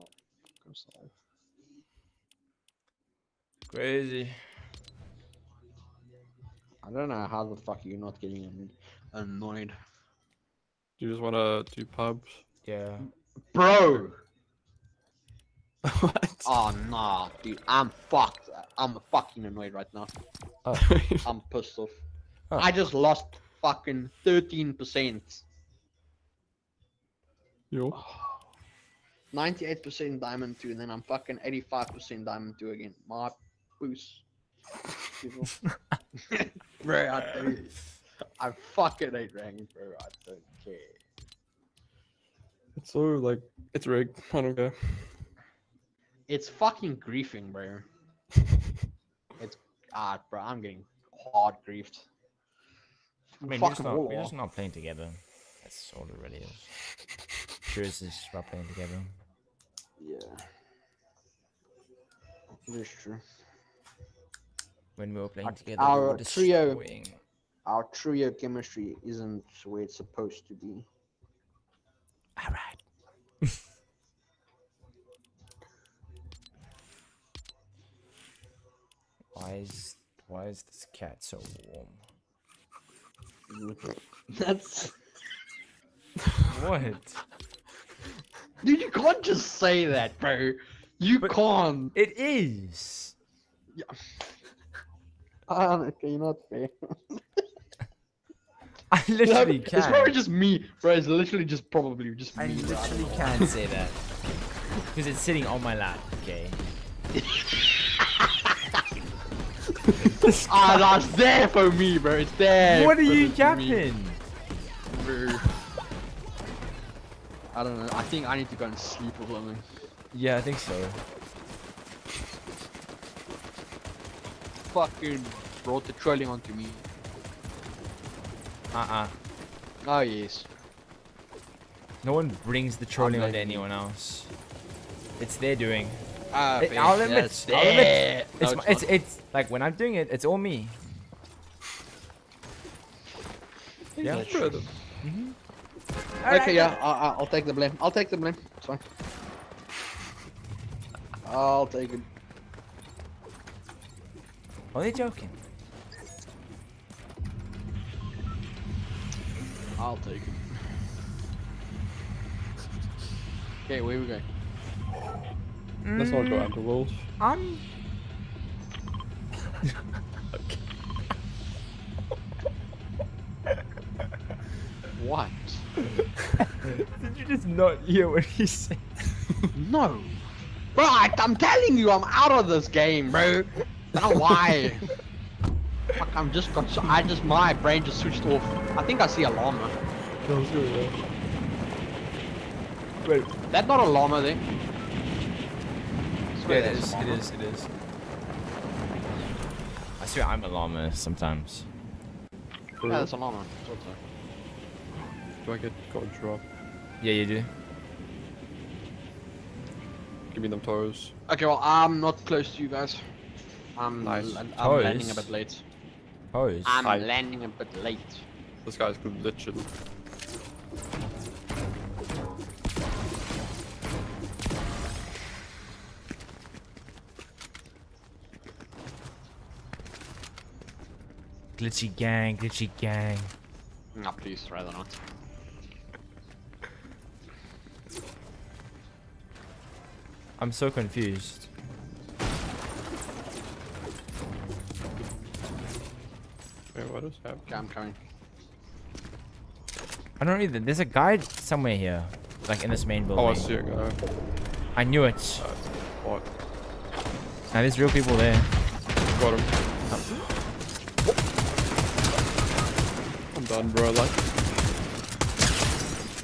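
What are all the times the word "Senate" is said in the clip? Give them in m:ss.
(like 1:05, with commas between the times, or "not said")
not said.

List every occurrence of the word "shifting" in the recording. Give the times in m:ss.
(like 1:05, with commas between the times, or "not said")
not said.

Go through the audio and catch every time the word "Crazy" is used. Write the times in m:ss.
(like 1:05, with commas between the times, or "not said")
0:03.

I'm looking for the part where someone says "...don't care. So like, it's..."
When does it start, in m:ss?
0:40.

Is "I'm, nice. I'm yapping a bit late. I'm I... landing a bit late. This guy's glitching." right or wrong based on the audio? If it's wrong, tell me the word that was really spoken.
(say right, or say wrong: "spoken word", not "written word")
wrong: "landing", not "yapping".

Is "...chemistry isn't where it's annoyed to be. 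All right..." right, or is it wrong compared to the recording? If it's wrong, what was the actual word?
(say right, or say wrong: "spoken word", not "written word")
wrong: "supposed", not "annoyed".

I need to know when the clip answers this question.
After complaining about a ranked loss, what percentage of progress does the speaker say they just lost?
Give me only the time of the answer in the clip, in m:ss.
0:24.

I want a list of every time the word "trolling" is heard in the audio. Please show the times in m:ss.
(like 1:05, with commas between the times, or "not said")
2:05, 2:12.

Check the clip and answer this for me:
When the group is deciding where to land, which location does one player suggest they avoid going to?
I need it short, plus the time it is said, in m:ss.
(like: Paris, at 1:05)
wolves, at 2:46.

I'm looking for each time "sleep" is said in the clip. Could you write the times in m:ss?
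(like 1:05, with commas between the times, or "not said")
1:58.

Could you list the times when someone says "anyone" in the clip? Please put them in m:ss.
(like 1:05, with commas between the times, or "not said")
2:13.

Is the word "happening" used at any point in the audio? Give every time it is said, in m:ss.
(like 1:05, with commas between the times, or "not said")
4:07.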